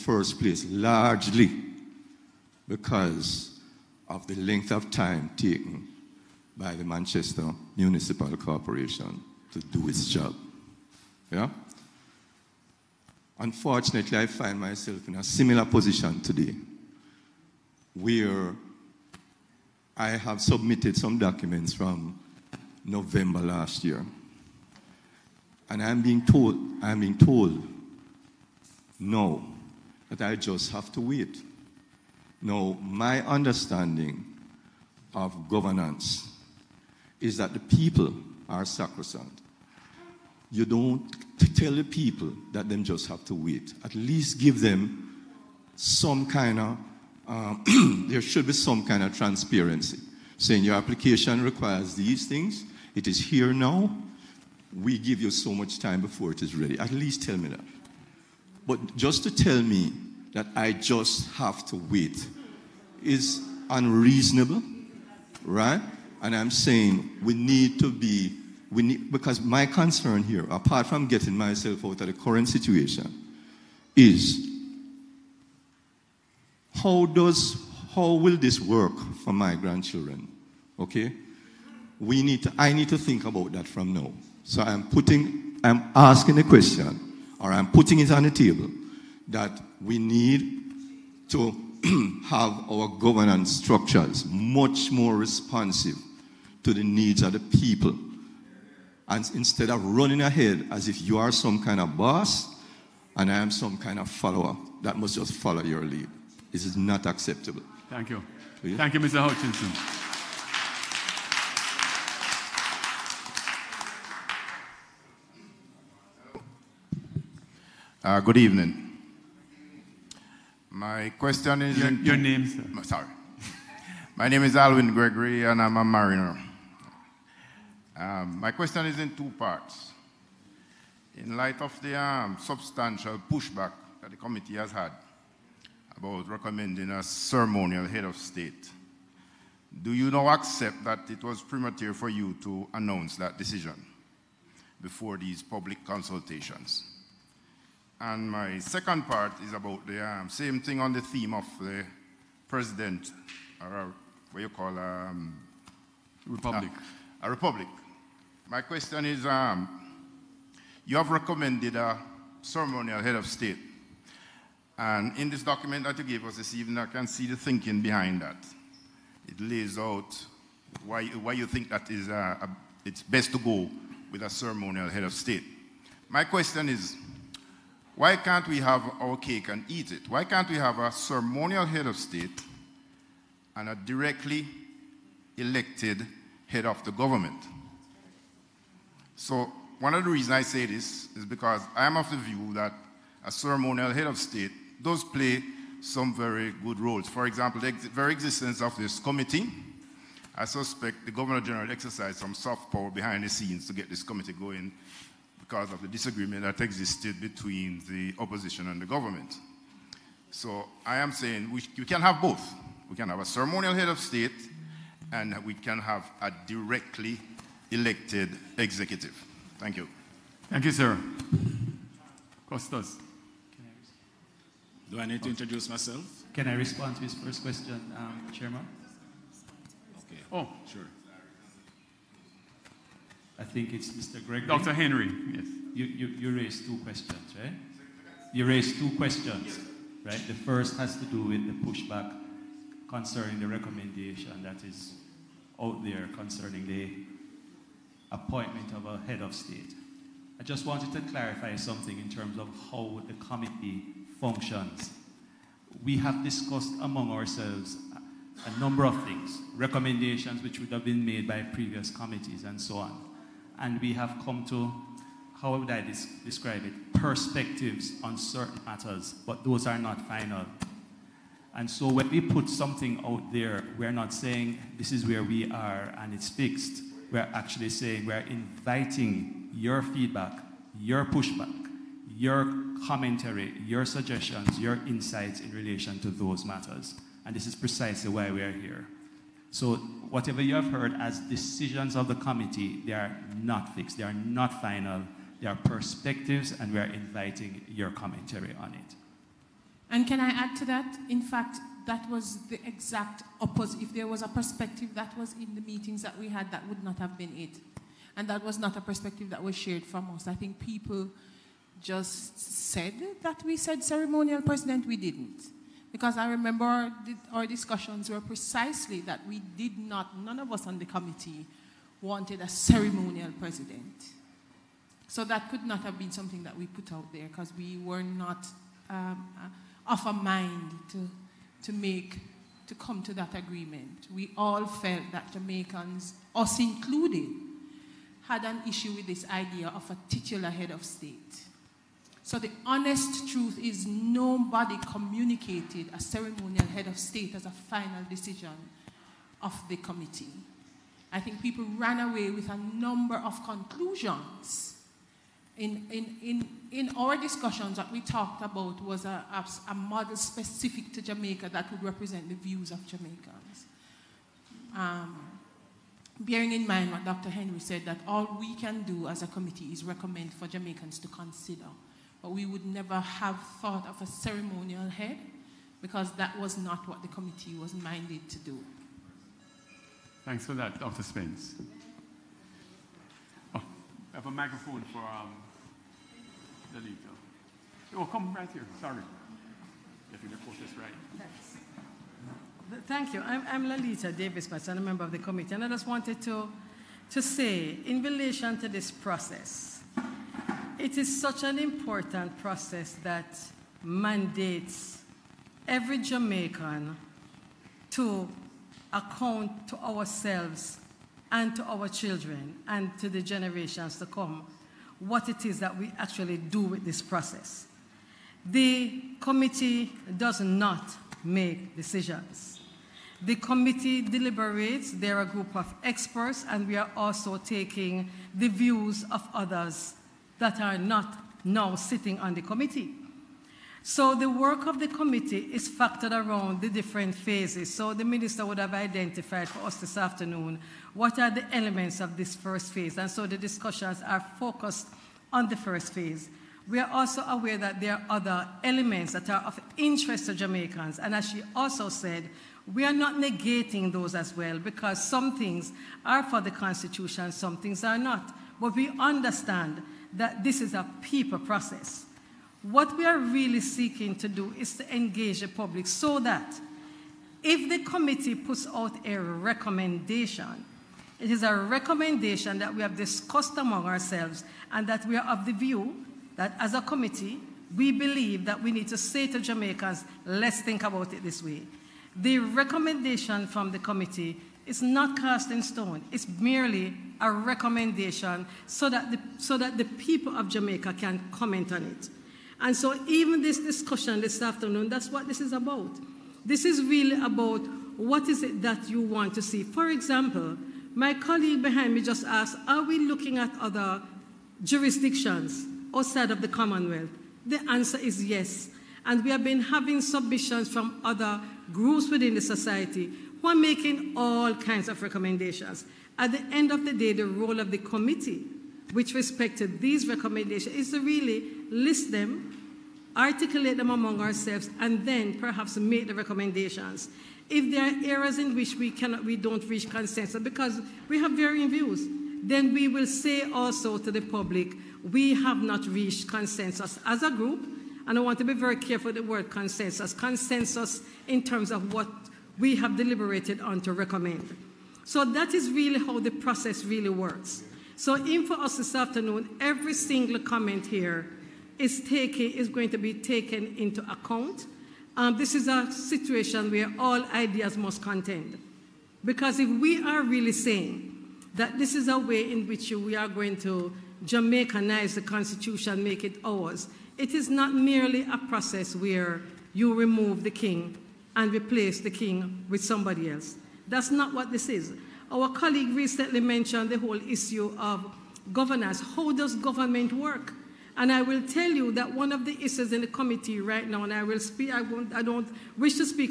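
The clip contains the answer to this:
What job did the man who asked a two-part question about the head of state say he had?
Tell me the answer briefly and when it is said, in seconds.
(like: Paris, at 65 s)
mariner, at 125 s.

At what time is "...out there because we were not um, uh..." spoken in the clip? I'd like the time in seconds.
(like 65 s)
326 s.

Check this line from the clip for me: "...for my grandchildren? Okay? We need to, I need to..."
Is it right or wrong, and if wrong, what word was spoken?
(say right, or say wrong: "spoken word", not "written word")
right.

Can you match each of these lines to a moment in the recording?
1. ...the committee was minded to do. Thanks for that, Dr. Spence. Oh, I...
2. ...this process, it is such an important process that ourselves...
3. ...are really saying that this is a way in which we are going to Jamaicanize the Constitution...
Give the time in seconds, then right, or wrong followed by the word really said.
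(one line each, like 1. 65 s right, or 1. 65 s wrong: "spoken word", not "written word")
1. 377 s right
2. 398 s wrong: "mandates", not "ourselves"
3. 560 s right.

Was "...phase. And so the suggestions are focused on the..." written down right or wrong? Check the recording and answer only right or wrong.
wrong.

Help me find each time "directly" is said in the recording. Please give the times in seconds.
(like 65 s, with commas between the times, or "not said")
183 s, 216 s.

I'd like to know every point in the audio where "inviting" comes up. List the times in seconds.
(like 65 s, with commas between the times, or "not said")
278 s, 296 s.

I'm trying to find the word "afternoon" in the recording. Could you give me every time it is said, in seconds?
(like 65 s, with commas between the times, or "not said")
439 s, 494 s, 548 s.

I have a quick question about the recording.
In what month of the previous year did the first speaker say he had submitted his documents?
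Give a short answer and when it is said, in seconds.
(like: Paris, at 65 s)
November, at 22 s.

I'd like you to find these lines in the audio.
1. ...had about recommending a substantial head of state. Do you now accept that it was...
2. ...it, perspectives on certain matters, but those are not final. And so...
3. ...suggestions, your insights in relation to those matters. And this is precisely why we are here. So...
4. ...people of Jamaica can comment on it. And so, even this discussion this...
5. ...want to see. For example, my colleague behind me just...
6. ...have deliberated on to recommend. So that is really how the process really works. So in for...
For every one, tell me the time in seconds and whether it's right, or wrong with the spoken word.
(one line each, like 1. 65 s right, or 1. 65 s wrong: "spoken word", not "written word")
1. 134 s wrong: "ceremonial", not "substantial"
2. 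266 s right
3. 283 s right
4. 489 s right
5. 499 s right
6. 542 s right.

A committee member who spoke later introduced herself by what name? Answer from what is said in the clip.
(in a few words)
Laleta Davis.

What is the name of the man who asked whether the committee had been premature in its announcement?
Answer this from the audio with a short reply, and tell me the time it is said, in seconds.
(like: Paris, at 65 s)
Alwin Gregory, at 124 s.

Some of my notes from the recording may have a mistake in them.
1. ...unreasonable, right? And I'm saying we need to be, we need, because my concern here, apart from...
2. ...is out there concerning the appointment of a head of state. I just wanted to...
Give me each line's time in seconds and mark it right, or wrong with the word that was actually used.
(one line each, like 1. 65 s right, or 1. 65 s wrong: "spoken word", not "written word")
1. 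63 s right
2. 244 s right.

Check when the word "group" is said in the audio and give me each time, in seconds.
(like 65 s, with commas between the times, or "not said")
425 s, 511 s, 537 s.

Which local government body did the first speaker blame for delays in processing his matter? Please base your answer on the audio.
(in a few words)
Manchester Municipal Corporation.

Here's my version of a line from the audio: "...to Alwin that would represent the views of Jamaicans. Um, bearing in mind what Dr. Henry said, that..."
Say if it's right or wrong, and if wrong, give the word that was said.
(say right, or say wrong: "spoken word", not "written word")
wrong: "Jamaica", not "Alwin".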